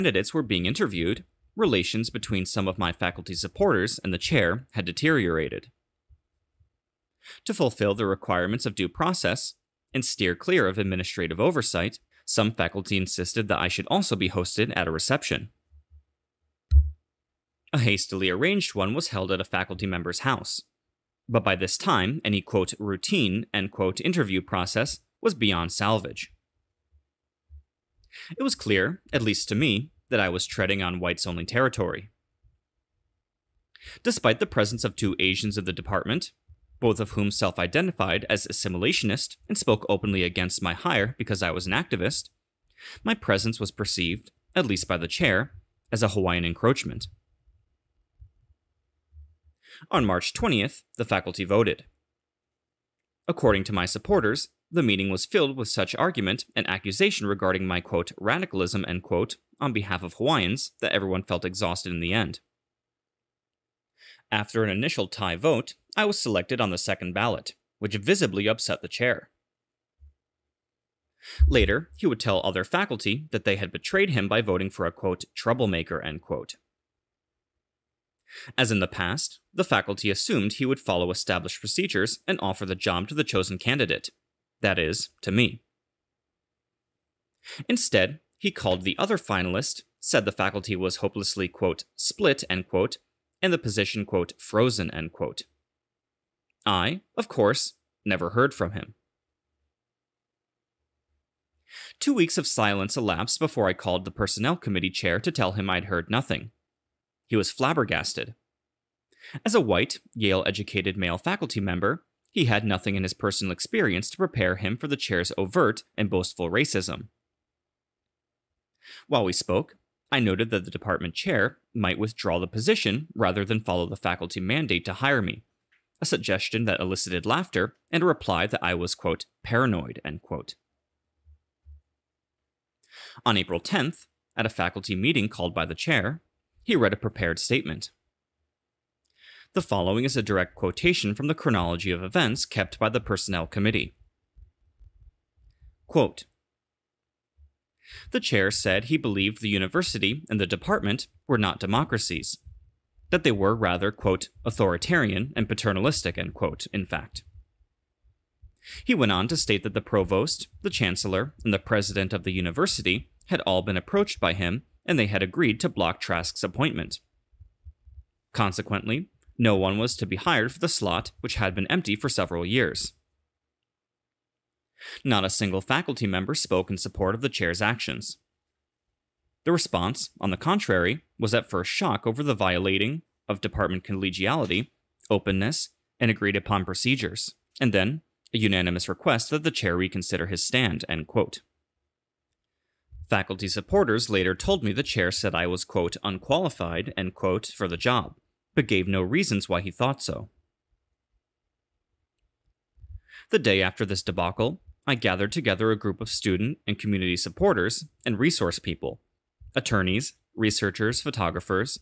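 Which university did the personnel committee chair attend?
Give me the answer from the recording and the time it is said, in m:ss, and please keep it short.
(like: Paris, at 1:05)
Yale, at 1:50.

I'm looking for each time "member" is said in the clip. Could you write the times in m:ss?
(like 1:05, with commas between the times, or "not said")
0:19, 1:51, 2:56.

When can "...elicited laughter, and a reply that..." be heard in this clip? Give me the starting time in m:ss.
2:06.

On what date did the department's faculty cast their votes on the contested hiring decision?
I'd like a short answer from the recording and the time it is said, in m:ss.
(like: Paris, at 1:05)
March 20, at 0:50.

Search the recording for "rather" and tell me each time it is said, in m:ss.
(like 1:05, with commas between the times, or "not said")
2:03, 2:33.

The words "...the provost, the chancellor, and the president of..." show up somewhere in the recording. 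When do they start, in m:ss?
2:39.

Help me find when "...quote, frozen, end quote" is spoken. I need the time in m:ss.
1:34.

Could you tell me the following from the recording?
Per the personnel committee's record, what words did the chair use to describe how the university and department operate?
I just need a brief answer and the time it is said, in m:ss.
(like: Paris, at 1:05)
authoritarian and paternalistic, at 2:34.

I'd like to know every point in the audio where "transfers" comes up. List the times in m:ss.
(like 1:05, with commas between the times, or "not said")
not said.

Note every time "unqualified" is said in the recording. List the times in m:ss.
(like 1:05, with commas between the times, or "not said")
3:16.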